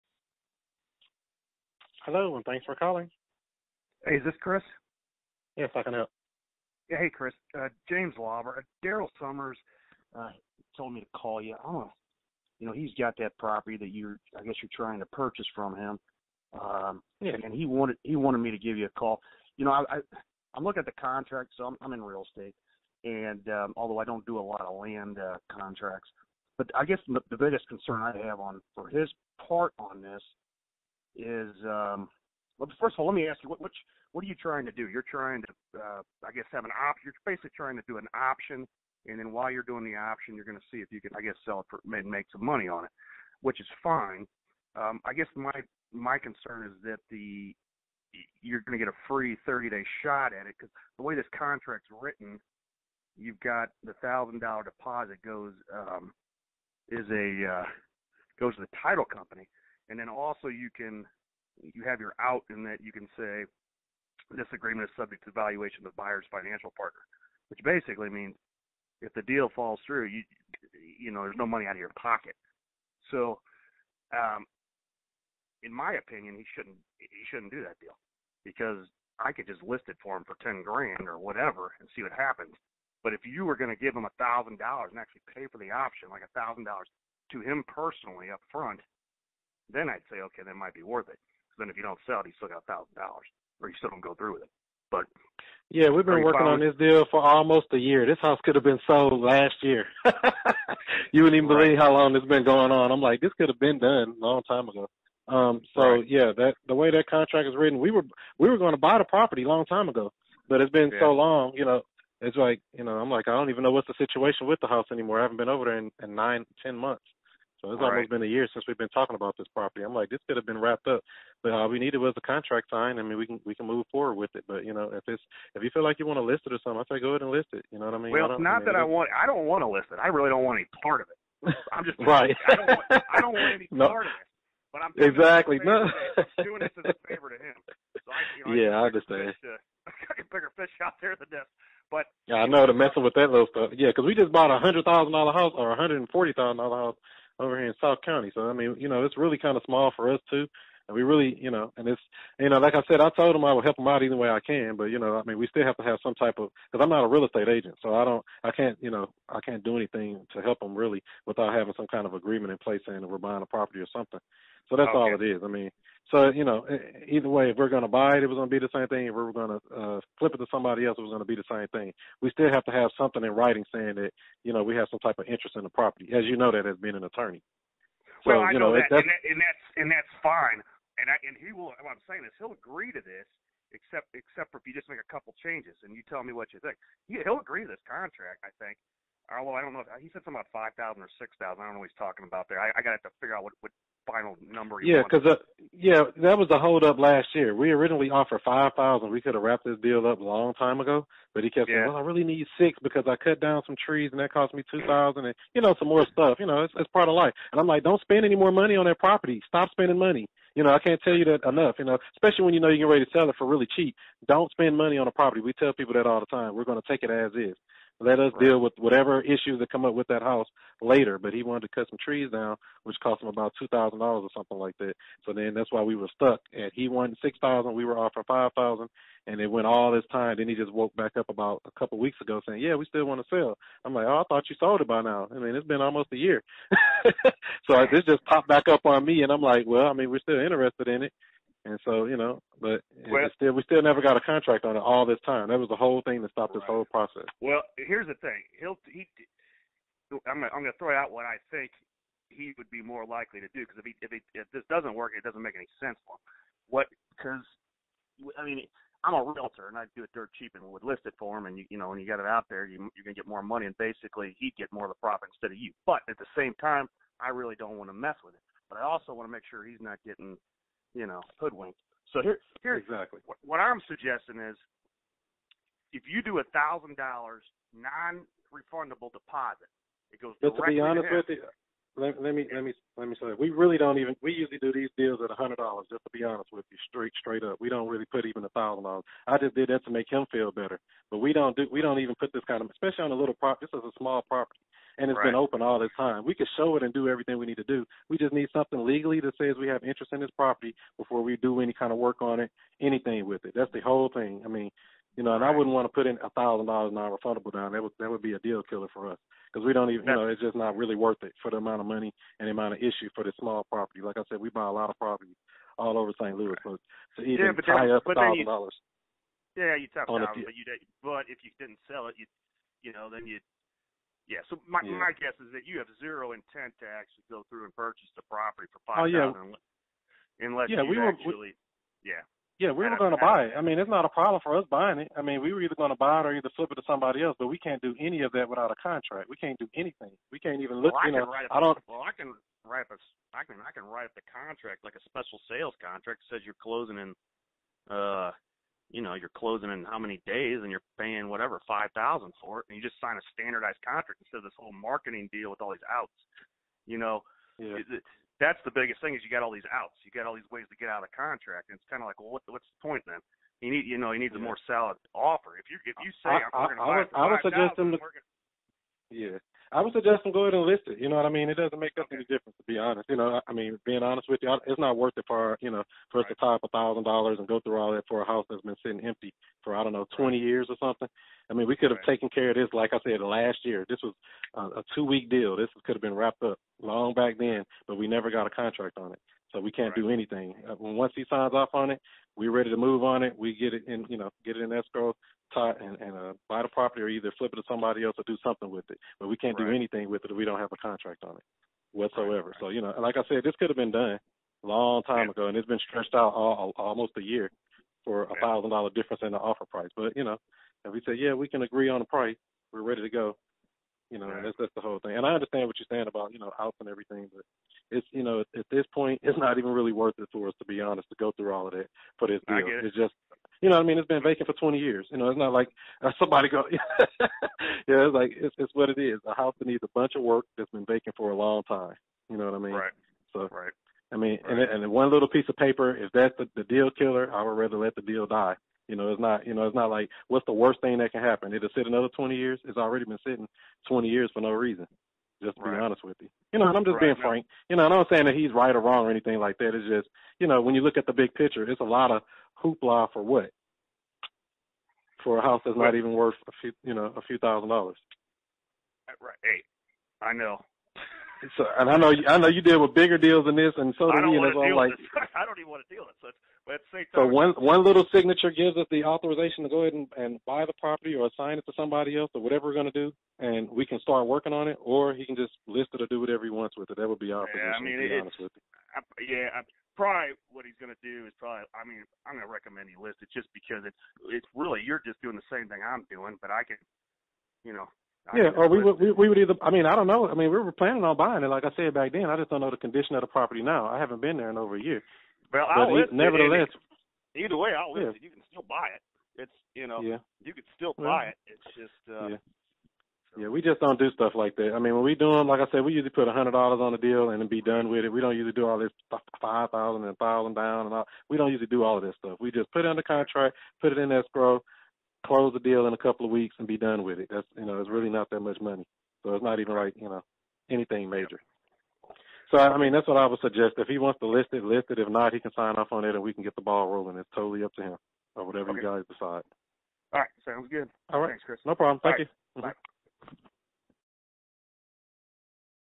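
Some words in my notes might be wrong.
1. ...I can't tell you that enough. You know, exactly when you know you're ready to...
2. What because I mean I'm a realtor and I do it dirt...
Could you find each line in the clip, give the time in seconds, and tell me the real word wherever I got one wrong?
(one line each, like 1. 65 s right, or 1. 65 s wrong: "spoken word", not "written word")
1. 210 s wrong: "especially", not "exactly"
2. 256 s right.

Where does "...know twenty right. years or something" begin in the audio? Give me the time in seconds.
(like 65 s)
379 s.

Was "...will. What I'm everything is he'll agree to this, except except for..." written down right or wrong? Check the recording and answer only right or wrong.
wrong.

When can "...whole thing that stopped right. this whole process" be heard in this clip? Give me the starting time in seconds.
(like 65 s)
245 s.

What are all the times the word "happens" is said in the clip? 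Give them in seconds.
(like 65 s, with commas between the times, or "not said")
82 s, 441 s.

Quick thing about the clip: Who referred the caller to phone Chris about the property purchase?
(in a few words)
Daryl Summers.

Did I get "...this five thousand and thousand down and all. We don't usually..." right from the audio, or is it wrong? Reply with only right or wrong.
right.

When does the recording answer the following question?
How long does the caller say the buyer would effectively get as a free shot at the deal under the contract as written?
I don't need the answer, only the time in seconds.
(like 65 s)
49 s.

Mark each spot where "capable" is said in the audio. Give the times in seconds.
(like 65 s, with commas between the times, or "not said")
not said.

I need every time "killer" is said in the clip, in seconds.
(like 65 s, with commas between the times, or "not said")
308 s, 436 s.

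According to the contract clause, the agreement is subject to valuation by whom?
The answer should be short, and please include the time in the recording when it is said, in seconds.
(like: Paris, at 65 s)
the buyer's financial partner, at 65 s.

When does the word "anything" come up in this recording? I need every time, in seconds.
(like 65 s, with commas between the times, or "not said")
159 s, 302 s, 339 s, 390 s, 399 s, 449 s, 520 s.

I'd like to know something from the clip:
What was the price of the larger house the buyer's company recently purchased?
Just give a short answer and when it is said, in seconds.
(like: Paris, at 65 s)
$140,000, at 145 s.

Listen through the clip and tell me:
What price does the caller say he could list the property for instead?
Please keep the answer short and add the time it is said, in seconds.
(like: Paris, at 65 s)
ten grand, at 80 s.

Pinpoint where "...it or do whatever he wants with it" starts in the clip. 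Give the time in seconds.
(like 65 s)
475 s.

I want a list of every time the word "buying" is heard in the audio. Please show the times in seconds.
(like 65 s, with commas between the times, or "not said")
163 s, 334 s, 491 s.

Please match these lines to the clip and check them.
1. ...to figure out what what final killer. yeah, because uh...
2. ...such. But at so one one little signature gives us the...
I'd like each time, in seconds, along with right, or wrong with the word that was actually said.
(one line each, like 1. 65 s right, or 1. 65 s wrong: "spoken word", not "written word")
1. 193 s wrong: "number", not "killer"
2. 466 s right.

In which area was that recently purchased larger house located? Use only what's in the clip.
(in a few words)
South County.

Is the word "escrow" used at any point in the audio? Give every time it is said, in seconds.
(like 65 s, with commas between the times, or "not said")
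394 s, 514 s.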